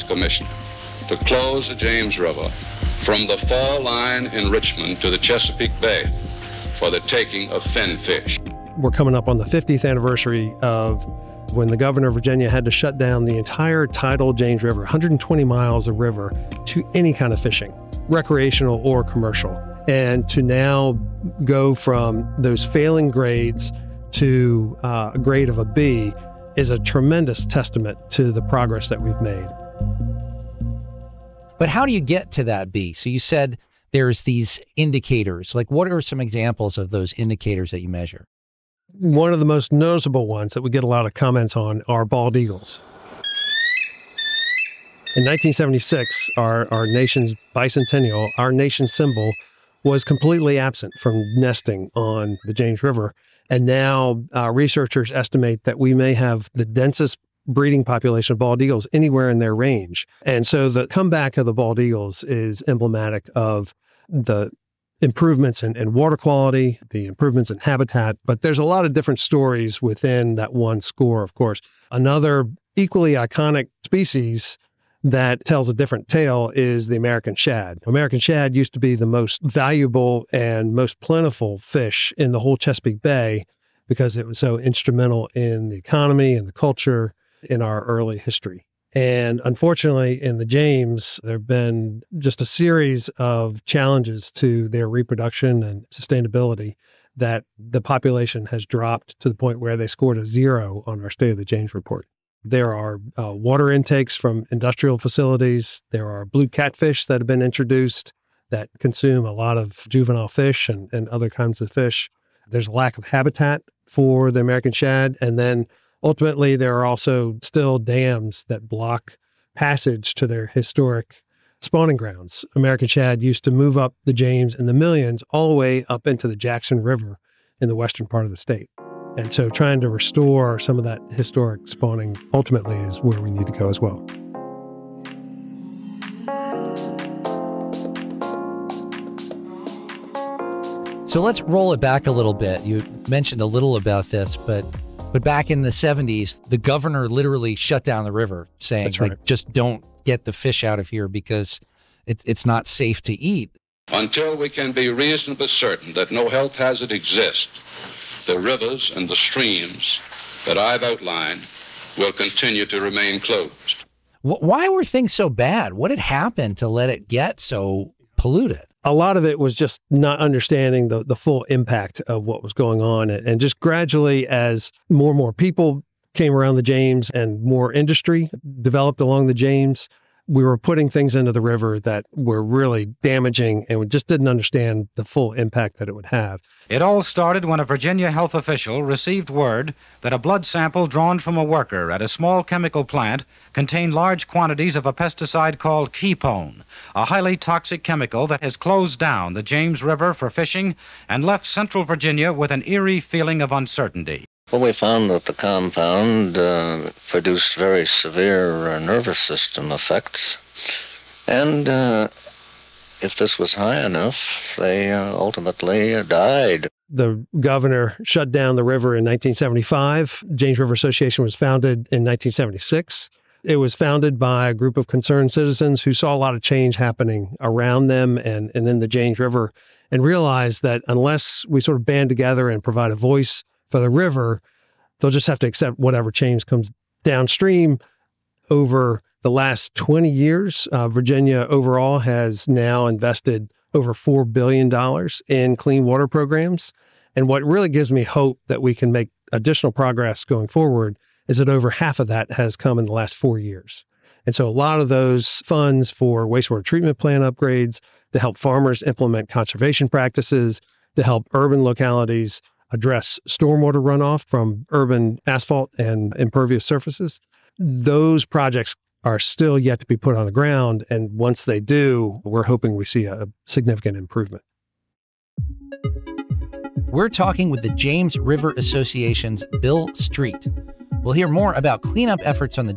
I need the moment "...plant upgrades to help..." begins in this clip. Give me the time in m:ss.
4:16.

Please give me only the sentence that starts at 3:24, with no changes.
Well, we found that the compound uh, produced very severe uh, nervous system effects.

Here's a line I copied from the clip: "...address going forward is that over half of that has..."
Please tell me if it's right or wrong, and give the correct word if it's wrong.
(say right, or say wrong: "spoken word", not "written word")
wrong: "progress", not "address".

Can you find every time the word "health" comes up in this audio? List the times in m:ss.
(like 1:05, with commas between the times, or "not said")
2:36, 3:08.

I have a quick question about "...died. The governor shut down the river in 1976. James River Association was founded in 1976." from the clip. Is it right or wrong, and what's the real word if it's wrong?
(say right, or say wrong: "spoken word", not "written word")
wrong: "1975", not "1976".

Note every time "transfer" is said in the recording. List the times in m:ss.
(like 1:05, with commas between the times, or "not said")
not said.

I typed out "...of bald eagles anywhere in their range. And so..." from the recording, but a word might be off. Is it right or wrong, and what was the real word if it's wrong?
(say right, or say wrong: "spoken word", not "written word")
right.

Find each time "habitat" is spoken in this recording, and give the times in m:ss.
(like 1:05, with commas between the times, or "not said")
1:07, 1:53.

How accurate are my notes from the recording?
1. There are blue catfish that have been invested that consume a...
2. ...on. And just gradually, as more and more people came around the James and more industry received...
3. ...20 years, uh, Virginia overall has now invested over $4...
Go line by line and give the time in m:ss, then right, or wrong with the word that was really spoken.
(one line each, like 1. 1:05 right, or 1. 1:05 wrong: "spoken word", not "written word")
1. 1:45 wrong: "introduced", not "invested"
2. 2:52 wrong: "developed", not "received"
3. 3:59 right.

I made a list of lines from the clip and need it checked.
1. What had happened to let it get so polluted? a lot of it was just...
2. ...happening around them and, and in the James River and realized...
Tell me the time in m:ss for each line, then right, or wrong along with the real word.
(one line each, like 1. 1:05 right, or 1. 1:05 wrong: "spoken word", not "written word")
1. 2:45 right
2. 3:46 right.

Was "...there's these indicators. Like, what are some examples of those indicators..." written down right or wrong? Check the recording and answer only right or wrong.
right.